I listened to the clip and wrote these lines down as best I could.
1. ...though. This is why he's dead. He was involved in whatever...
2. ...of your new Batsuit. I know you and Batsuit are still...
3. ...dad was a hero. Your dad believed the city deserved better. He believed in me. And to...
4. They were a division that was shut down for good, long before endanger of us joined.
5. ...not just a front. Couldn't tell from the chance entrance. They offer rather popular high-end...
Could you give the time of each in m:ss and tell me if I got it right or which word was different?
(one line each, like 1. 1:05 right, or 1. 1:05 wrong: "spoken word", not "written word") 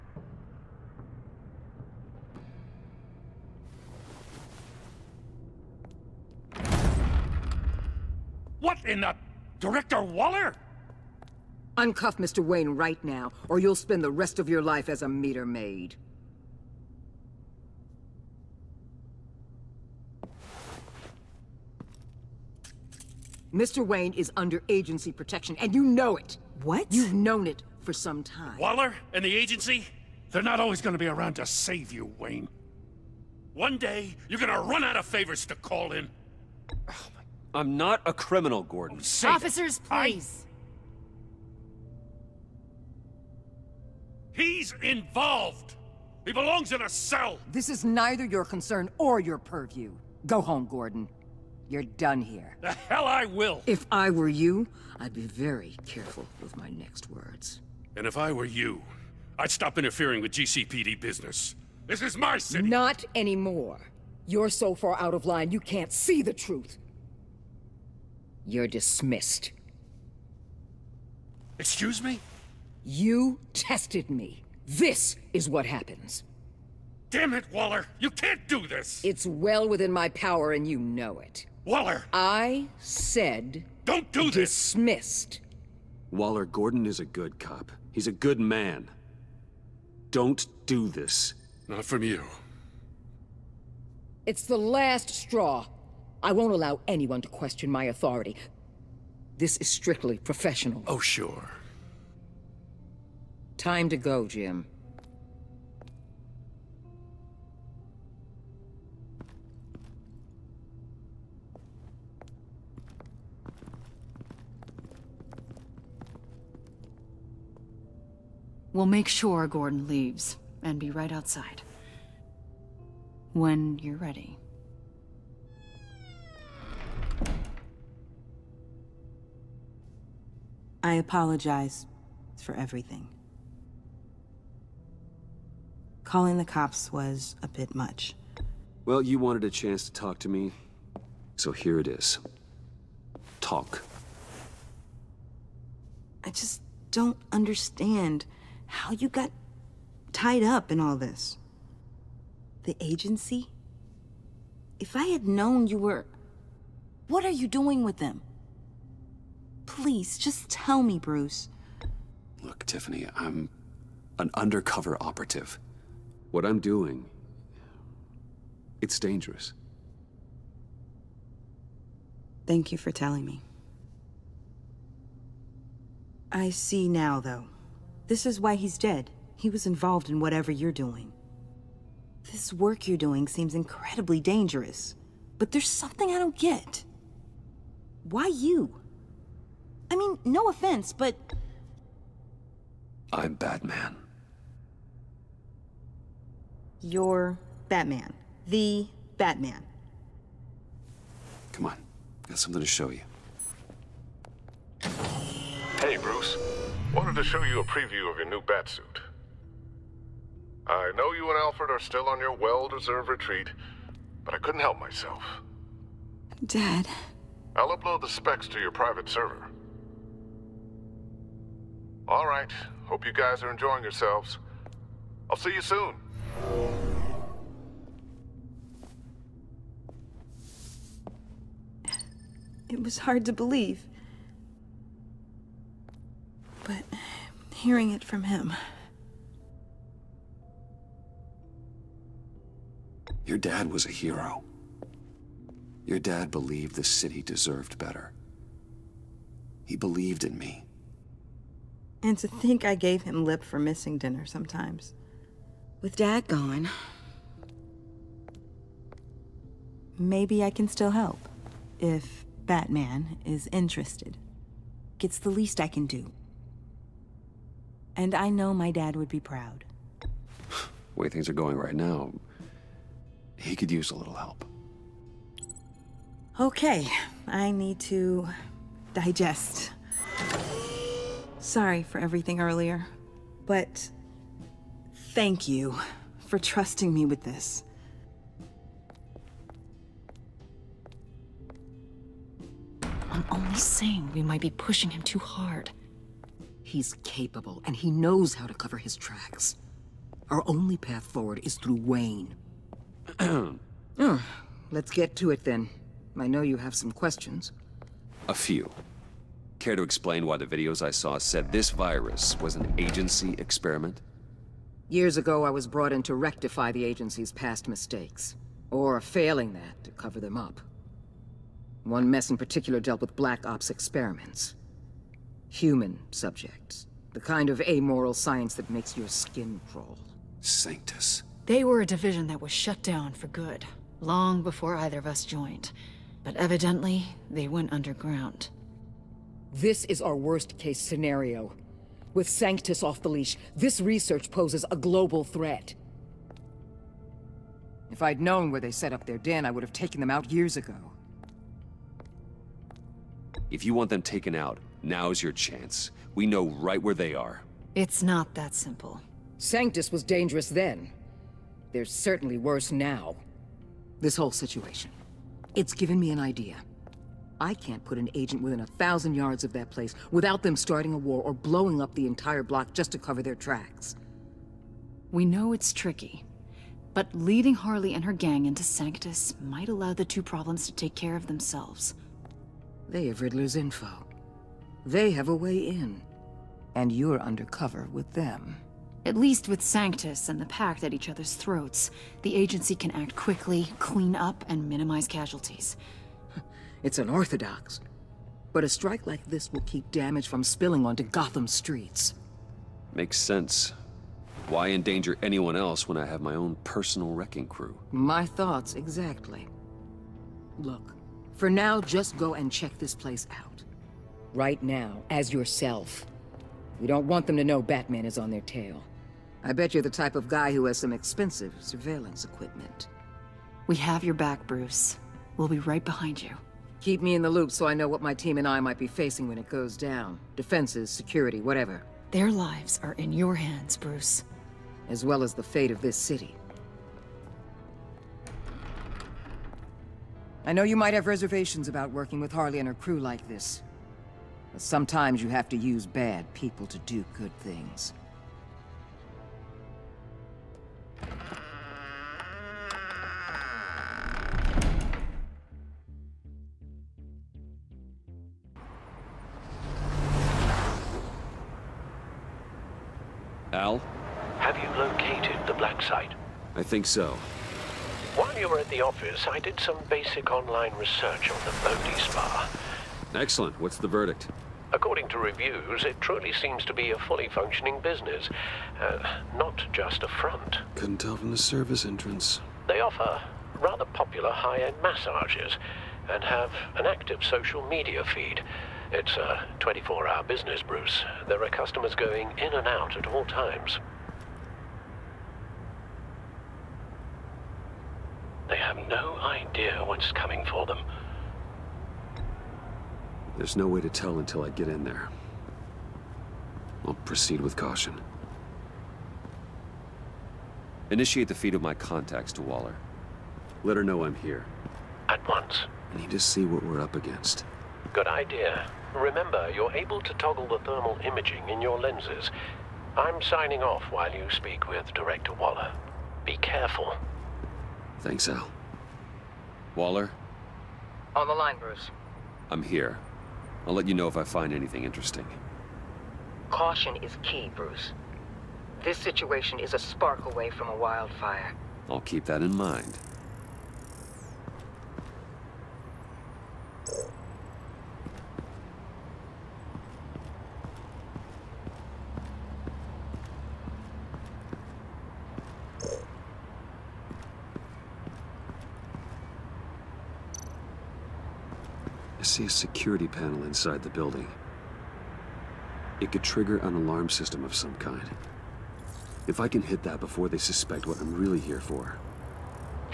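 1. 2:57 right
2. 3:28 wrong: "Alfred", not "Batsuit"
3. 4:03 right
4. 5:31 wrong: "either", not "endanger"
5. 7:59 wrong: "service", not "chance".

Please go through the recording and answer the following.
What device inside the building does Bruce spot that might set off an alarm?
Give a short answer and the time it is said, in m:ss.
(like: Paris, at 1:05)
Security panel, at 9:22.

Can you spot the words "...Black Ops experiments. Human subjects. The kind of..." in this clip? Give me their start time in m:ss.
5:23.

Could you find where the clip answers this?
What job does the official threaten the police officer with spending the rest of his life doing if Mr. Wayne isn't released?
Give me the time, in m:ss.
0:15.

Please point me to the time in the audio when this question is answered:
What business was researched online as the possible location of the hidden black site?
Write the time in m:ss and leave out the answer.
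7:51.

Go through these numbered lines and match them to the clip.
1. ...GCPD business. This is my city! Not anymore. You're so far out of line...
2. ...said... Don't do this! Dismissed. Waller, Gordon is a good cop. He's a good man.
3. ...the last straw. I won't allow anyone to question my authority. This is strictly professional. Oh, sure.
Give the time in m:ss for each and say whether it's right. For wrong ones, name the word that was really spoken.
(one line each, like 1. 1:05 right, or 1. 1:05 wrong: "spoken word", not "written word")
1. 1:00 right
2. 1:22 right
3. 1:34 right.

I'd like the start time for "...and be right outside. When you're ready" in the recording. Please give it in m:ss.
2:00.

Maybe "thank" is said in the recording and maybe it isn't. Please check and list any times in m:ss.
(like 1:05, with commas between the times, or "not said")
2:52, 4:45, 8:48.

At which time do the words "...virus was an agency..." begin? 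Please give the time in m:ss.
5:11.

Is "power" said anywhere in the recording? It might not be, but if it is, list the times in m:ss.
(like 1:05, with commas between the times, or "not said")
1:20.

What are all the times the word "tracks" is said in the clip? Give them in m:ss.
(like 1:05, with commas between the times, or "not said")
4:58, 6:13.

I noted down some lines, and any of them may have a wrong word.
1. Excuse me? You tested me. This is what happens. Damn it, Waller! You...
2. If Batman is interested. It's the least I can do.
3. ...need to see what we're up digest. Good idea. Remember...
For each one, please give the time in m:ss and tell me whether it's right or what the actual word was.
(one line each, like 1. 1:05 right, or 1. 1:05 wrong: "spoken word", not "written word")
1. 1:11 right
2. 4:21 right
3. 8:36 wrong: "against", not "digest".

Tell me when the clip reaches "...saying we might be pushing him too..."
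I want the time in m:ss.
4:53.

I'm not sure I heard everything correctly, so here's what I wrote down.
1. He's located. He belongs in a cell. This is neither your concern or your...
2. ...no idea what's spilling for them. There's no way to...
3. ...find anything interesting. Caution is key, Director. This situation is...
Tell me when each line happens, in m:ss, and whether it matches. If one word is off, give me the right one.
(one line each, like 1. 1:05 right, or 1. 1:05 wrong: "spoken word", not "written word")
1. 0:44 wrong: "involved", not "located"
2. 8:18 wrong: "coming", not "spilling"
3. 8:54 wrong: "Bruce", not "Director".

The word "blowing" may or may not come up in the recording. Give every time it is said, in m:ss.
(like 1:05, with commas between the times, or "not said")
6:11.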